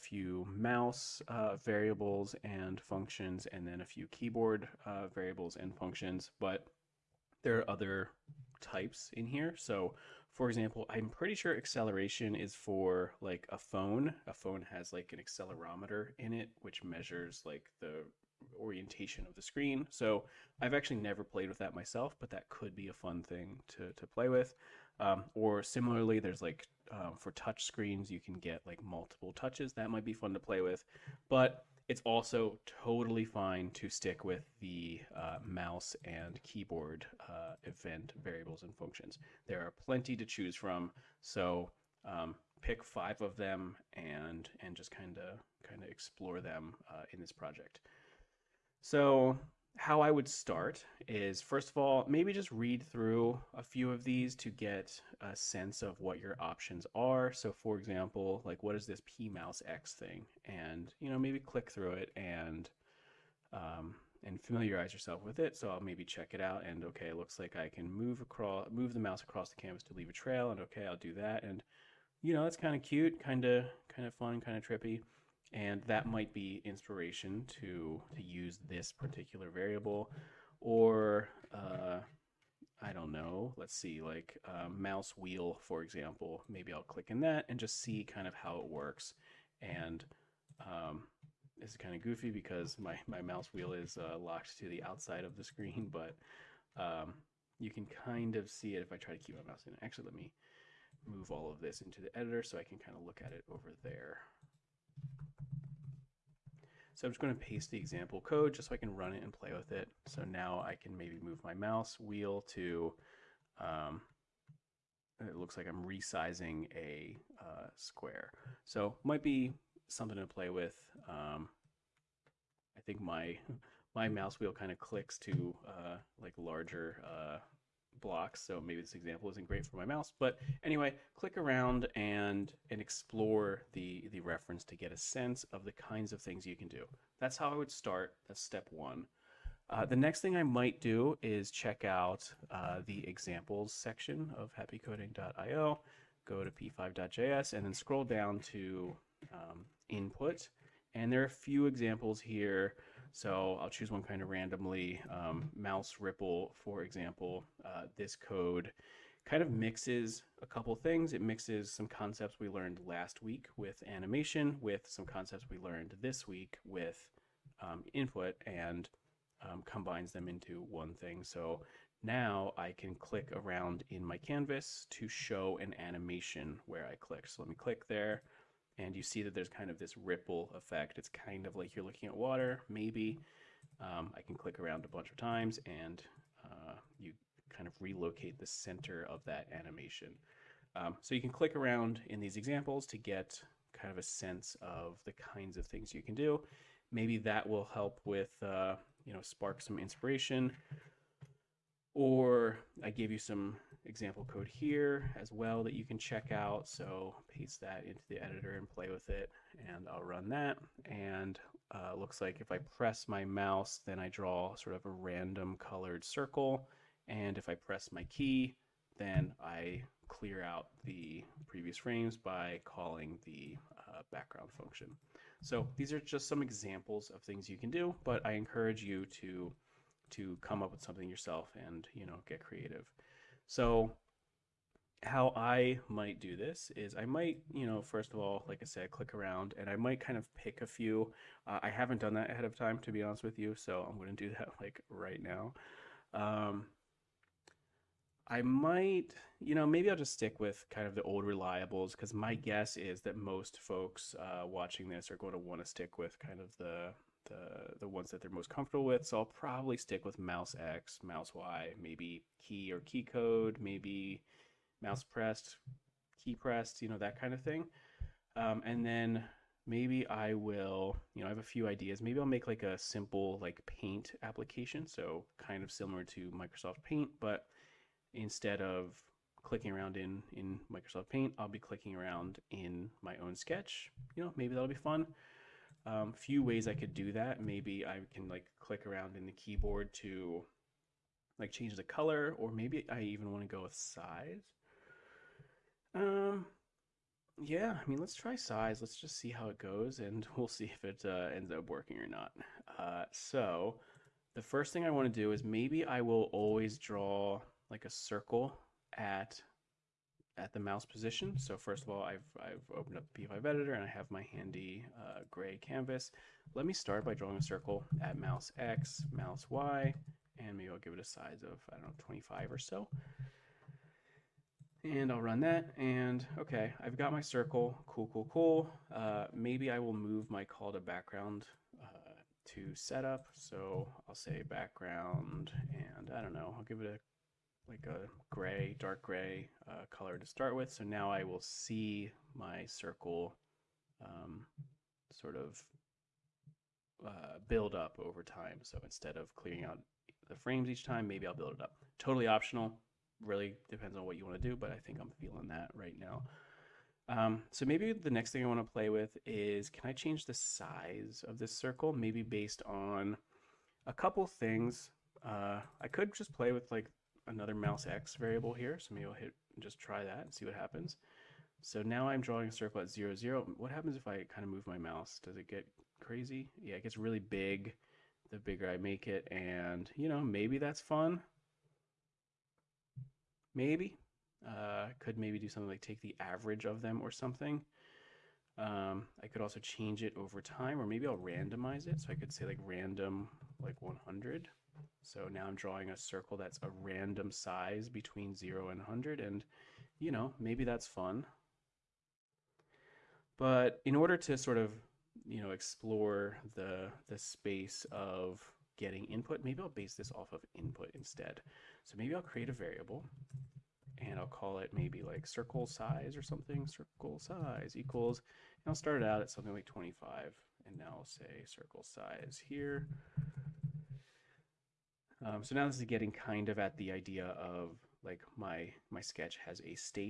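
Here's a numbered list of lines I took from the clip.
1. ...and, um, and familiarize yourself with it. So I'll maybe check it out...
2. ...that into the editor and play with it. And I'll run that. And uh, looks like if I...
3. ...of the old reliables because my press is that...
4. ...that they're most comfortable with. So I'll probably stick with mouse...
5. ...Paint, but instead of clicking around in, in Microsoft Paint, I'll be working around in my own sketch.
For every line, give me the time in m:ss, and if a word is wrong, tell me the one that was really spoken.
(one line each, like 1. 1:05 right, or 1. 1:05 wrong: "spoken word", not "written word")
1. 1:02 right
2. 3:27 right
3. 4:10 wrong: "guess", not "press"
4. 4:18 right
5. 4:36 wrong: "clicking", not "working".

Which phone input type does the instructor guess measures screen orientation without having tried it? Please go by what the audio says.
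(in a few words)
acceleration.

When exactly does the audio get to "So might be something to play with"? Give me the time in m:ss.
1:58.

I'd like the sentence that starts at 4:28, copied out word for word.
Um, and then maybe I will, you know, I have a few ideas.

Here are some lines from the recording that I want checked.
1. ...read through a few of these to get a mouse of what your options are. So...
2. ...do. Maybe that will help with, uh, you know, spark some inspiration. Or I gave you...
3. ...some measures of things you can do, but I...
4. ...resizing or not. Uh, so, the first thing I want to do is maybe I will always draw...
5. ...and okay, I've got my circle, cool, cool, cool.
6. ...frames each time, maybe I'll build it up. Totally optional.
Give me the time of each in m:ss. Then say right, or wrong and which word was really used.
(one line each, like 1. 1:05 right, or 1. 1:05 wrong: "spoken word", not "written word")
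1. 0:52 wrong: "sense", not "mouse"
2. 3:16 right
3. 3:46 wrong: "examples", not "measures"
4. 5:01 wrong: "working", not "resizing"
5. 5:25 right
6. 5:50 right.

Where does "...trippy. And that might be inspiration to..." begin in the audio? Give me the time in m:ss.
1:14.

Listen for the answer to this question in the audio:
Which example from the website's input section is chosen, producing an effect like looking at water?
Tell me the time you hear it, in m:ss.
2:35.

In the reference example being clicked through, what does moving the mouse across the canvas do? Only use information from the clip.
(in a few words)
leave a trail.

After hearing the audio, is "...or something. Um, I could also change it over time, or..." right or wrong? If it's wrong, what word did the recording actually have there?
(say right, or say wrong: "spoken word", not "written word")
right.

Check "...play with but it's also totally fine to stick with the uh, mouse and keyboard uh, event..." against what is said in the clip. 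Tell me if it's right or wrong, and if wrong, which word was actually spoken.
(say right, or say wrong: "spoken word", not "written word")
right.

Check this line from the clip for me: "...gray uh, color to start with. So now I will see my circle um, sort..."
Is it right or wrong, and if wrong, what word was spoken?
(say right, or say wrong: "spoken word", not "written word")
right.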